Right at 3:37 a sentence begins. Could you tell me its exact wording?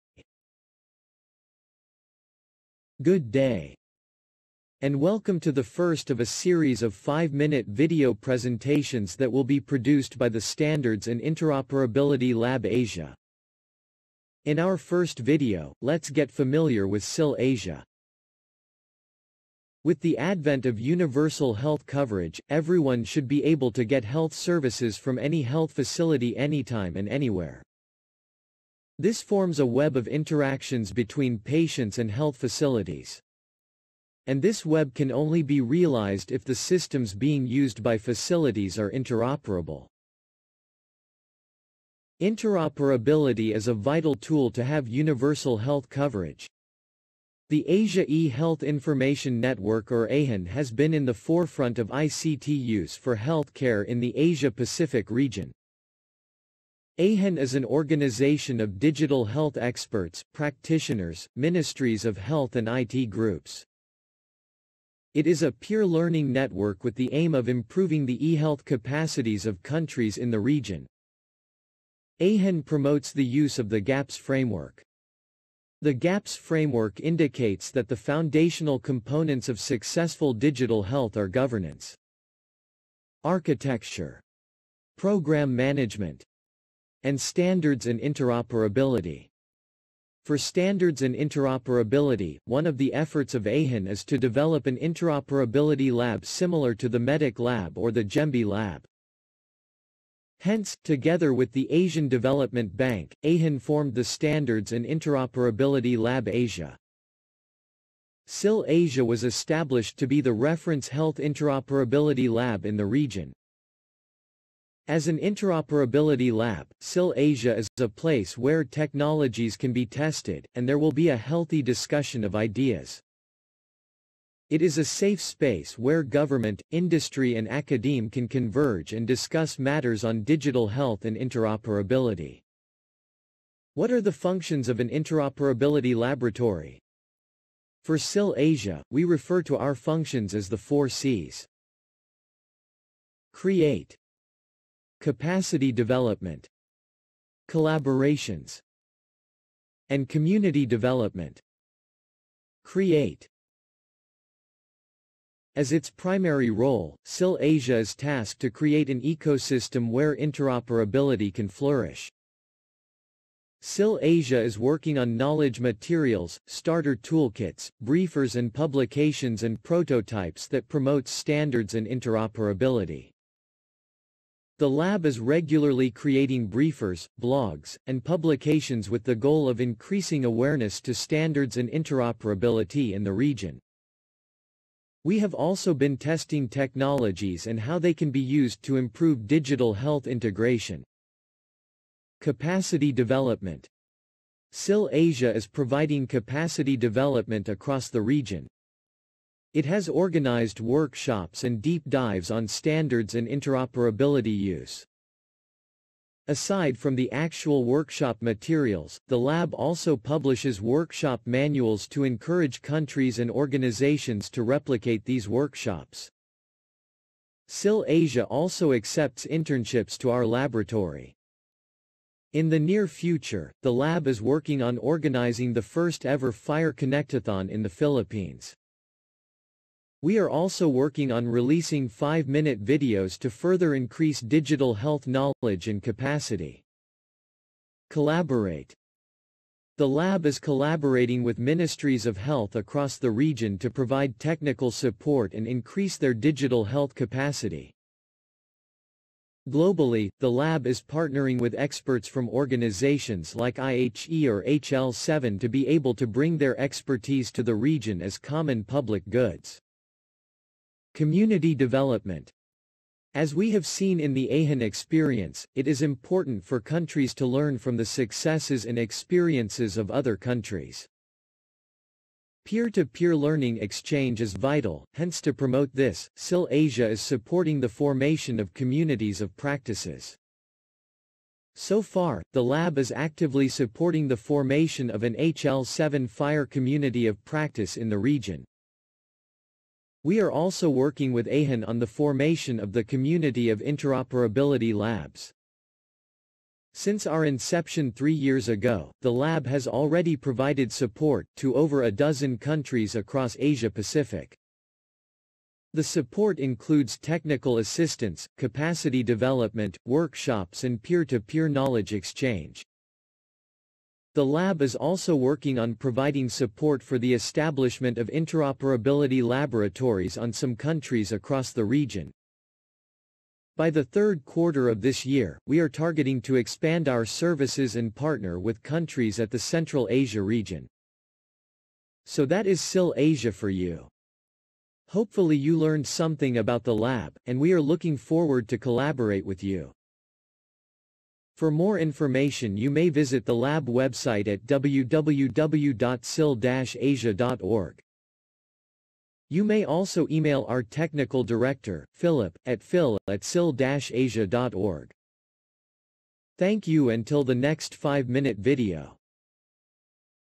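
SIL Asia also accepts internships to our laboratory.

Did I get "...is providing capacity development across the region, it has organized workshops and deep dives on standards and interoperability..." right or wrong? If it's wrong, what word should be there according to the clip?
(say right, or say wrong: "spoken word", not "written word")
right.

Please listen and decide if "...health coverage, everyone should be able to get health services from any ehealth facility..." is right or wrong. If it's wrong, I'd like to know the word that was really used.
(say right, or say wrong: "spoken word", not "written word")
wrong: "health", not "ehealth".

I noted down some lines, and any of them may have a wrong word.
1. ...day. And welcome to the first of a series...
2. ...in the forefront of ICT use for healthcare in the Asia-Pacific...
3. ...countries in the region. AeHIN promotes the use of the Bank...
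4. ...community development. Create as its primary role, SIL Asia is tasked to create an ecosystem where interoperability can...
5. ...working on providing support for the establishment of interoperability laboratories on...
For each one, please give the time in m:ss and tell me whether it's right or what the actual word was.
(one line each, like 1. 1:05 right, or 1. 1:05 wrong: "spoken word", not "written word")
1. 0:03 right
2. 0:50 right
3. 1:09 wrong: "GAPS", not "Bank"
4. 2:30 right
5. 5:15 right.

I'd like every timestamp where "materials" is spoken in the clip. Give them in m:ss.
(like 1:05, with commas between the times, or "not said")
2:45, 3:28.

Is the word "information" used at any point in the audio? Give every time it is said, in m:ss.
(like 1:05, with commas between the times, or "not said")
0:48, 5:41.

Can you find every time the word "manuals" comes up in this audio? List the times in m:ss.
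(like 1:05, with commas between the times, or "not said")
3:31.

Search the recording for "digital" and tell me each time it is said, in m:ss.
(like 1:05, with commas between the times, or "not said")
0:58, 1:20, 2:10, 3:09, 3:54, 4:06.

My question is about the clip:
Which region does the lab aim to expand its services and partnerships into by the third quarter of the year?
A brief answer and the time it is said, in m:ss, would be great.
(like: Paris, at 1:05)
Central Asia, at 5:29.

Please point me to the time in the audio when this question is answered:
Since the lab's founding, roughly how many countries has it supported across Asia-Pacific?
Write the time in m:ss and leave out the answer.
5:01.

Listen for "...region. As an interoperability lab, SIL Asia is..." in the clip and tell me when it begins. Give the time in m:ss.
1:52.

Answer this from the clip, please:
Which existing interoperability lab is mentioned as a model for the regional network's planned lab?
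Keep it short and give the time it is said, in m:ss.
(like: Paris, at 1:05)
MEDIC lab, at 1:36.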